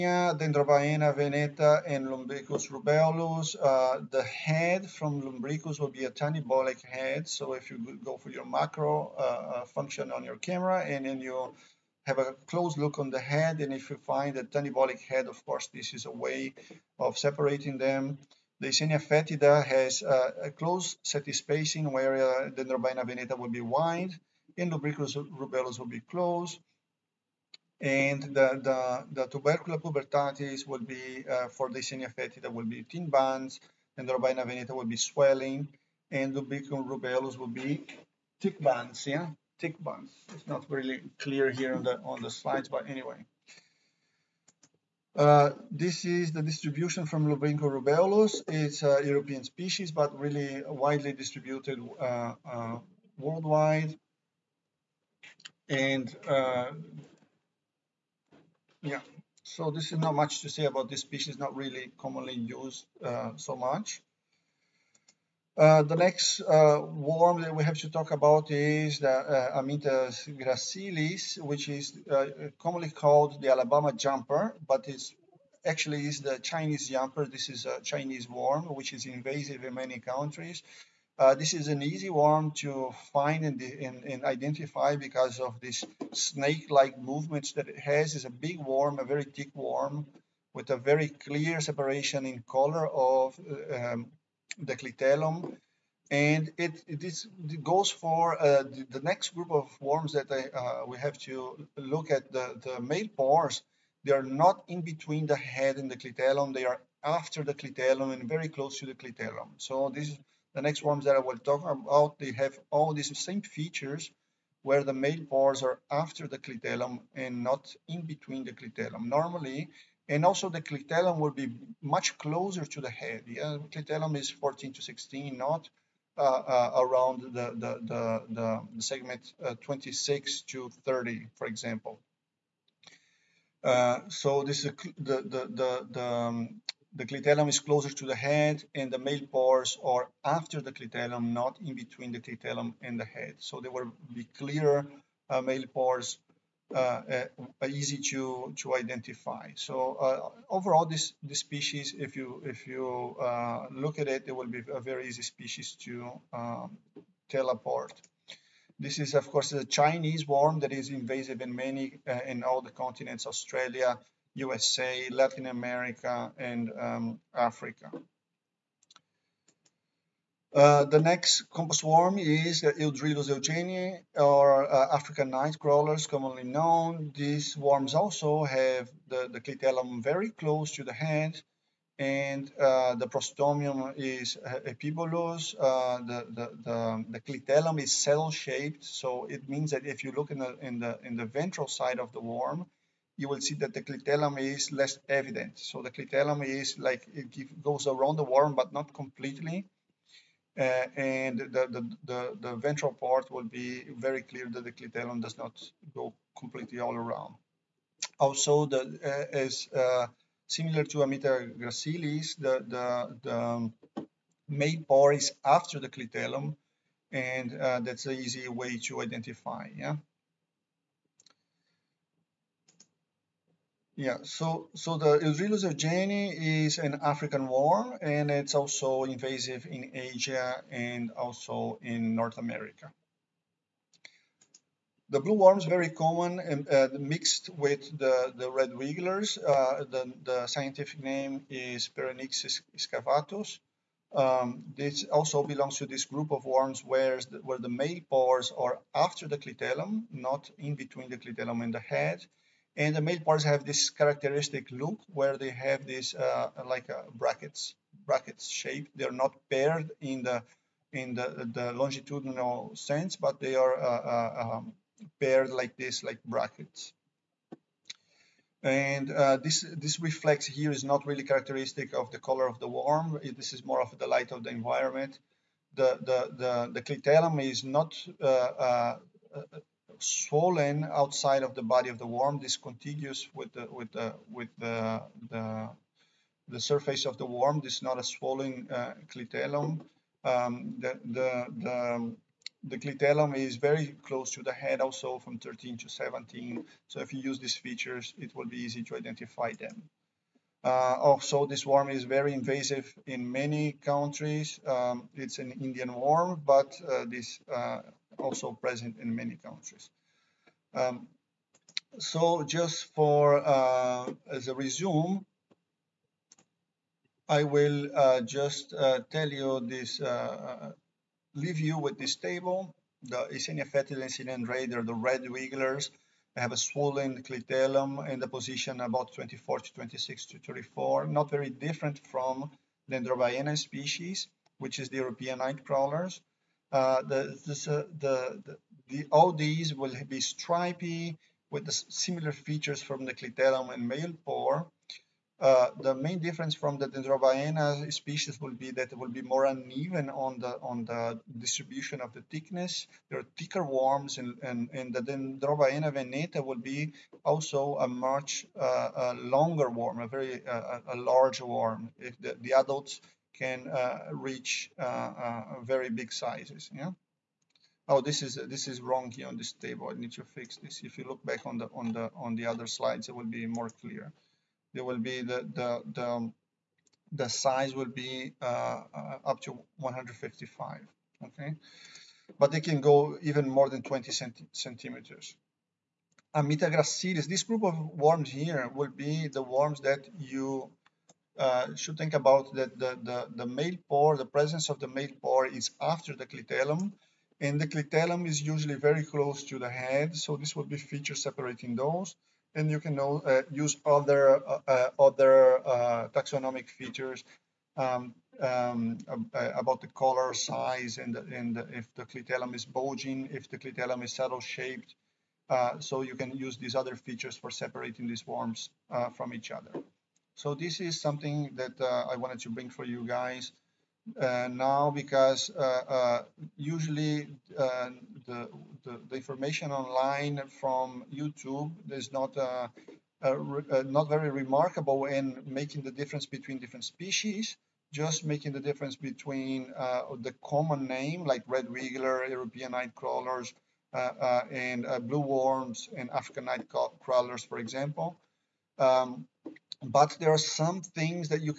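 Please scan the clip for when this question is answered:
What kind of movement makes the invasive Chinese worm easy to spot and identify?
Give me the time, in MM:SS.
01:26.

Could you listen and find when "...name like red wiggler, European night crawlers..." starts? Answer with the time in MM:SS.
07:20.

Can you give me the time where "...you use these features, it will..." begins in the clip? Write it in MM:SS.
04:57.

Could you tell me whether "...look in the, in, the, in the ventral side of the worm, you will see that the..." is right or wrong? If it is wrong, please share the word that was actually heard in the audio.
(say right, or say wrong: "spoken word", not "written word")
right.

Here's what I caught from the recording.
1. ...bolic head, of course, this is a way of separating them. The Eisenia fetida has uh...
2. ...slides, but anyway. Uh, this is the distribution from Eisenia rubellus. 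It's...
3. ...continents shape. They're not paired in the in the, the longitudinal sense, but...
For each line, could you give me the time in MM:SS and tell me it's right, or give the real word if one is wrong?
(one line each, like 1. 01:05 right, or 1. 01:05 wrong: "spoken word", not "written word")
1. 00:14 right
2. 00:42 wrong: "Lumbricus", not "Eisenia"
3. 04:18 wrong: "brackets", not "continents".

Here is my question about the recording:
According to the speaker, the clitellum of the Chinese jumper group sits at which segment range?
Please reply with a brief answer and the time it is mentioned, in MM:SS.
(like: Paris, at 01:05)
14 to 16, at 02:04.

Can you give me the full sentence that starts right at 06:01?
If the, the adults can uh, reach uh, uh, very big sizes.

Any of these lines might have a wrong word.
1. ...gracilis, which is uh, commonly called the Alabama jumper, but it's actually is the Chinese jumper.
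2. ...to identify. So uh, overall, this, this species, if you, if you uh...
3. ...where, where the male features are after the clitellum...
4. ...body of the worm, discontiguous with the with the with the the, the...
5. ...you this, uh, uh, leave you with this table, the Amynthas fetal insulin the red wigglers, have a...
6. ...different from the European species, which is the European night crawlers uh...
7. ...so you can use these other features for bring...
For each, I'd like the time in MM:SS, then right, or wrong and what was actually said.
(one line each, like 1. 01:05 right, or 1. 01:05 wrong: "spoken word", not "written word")
1. 01:10 right
2. 02:28 right
3. 04:06 wrong: "pores", not "features"
4. 04:41 right
5. 05:19 wrong: "Eisenia", not "Amynthas"
6. 05:31 wrong: "Dendrobaena", not "European"
7. 06:55 wrong: "separating", not "bring".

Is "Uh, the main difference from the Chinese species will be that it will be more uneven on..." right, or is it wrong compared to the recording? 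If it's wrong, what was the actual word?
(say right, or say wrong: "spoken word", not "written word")
wrong: "Dendrobaena", not "Chinese".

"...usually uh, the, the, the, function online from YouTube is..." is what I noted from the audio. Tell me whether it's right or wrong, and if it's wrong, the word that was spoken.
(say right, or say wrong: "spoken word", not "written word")
wrong: "information", not "function".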